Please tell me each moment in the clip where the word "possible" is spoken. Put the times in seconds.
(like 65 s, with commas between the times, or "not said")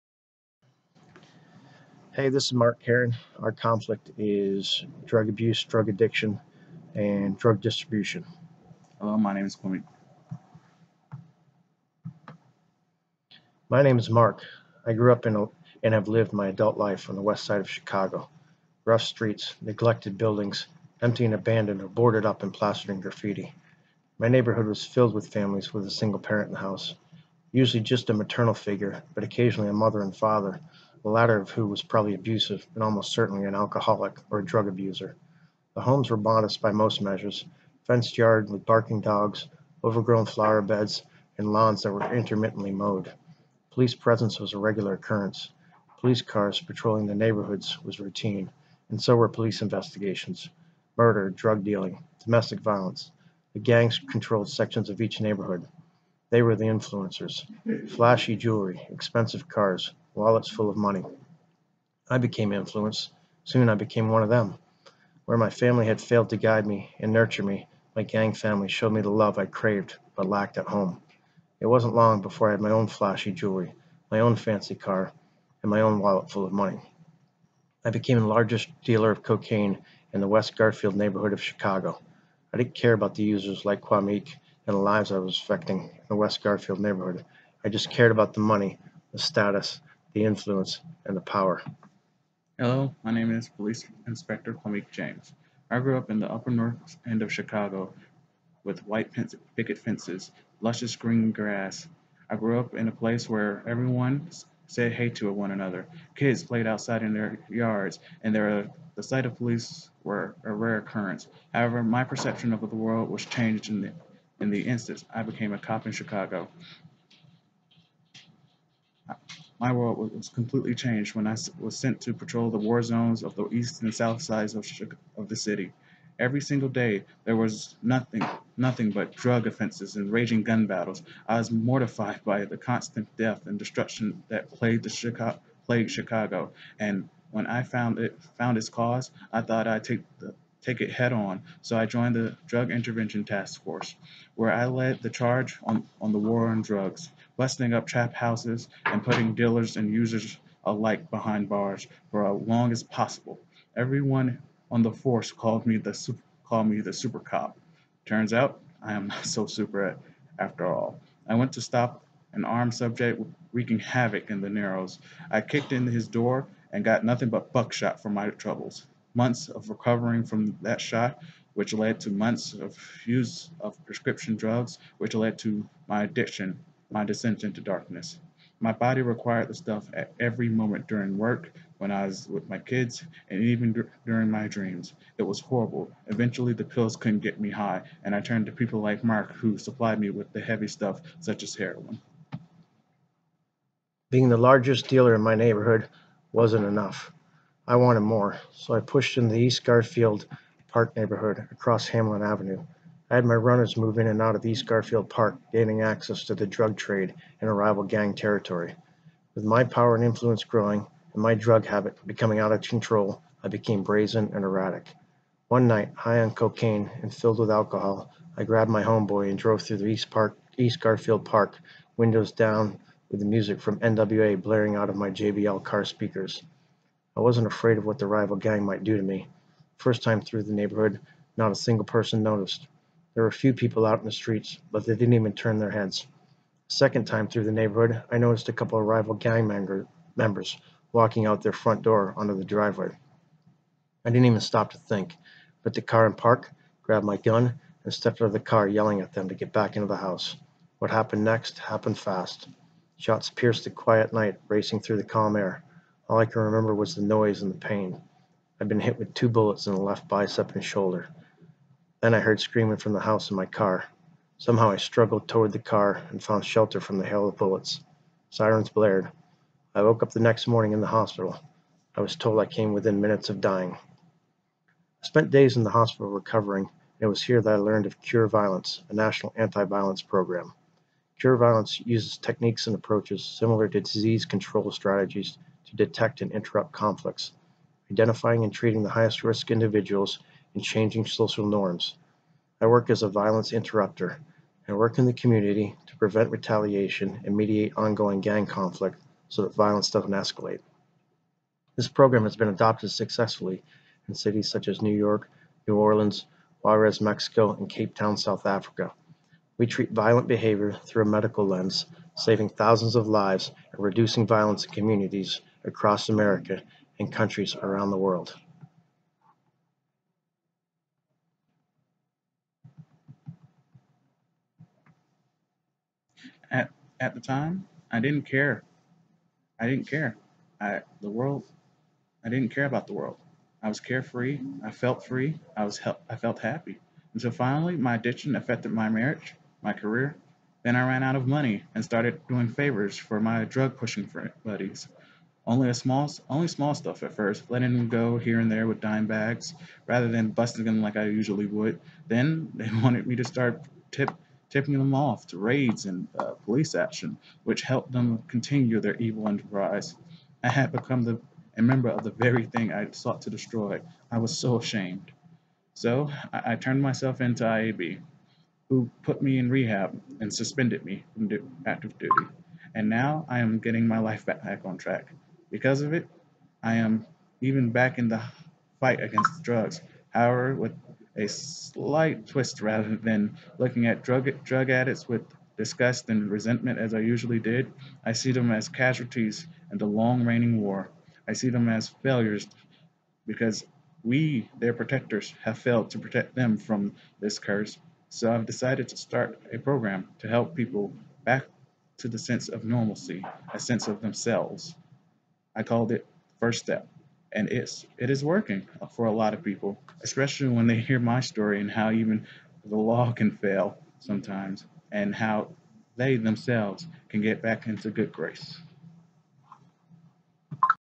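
152 s.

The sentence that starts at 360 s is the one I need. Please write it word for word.
I had become the, a member of the very thing I sought to destroy.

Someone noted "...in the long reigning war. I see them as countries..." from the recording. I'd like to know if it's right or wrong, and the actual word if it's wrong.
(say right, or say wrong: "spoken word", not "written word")
wrong: "failures", not "countries".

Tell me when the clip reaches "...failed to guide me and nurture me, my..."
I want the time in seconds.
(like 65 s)
66 s.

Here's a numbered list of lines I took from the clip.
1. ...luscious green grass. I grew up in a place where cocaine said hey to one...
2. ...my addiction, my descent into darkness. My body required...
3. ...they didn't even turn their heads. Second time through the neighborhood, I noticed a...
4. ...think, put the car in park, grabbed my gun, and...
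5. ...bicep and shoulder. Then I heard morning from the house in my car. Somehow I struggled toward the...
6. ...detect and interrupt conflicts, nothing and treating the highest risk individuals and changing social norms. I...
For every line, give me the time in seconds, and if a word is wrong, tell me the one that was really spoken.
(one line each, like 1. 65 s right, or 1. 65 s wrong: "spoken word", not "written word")
1. 100 s wrong: "everyone", not "cocaine"
2. 175 s right
3. 234 s right
4. 244 s right
5. 260 s wrong: "screaming", not "morning"
6. 285 s wrong: "identifying", not "nothing".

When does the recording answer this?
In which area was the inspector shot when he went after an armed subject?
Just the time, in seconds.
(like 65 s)
164 s.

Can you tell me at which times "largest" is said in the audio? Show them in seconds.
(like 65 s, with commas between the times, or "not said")
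78 s, 194 s.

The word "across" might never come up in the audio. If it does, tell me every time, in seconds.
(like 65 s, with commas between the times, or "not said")
201 s, 315 s.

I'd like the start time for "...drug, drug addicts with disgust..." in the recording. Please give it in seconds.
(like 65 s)
384 s.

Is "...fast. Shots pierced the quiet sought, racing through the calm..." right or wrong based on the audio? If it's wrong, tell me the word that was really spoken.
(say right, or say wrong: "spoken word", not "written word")
wrong: "night", not "sought".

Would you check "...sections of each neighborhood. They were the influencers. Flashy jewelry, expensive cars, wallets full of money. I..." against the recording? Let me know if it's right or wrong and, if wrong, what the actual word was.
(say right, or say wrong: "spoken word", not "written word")
right.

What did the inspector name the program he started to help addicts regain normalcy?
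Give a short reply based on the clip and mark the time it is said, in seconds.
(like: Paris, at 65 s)
First Step, at 406 s.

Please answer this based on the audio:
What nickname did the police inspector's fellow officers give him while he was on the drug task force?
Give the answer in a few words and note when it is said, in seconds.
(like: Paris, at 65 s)
super cop, at 156 s.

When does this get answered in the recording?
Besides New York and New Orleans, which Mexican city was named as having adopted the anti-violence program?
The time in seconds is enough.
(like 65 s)
306 s.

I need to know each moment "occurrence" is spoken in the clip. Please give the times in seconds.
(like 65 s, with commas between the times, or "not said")
44 s, 110 s.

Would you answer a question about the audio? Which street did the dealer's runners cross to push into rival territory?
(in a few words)
Hamlin Avenue.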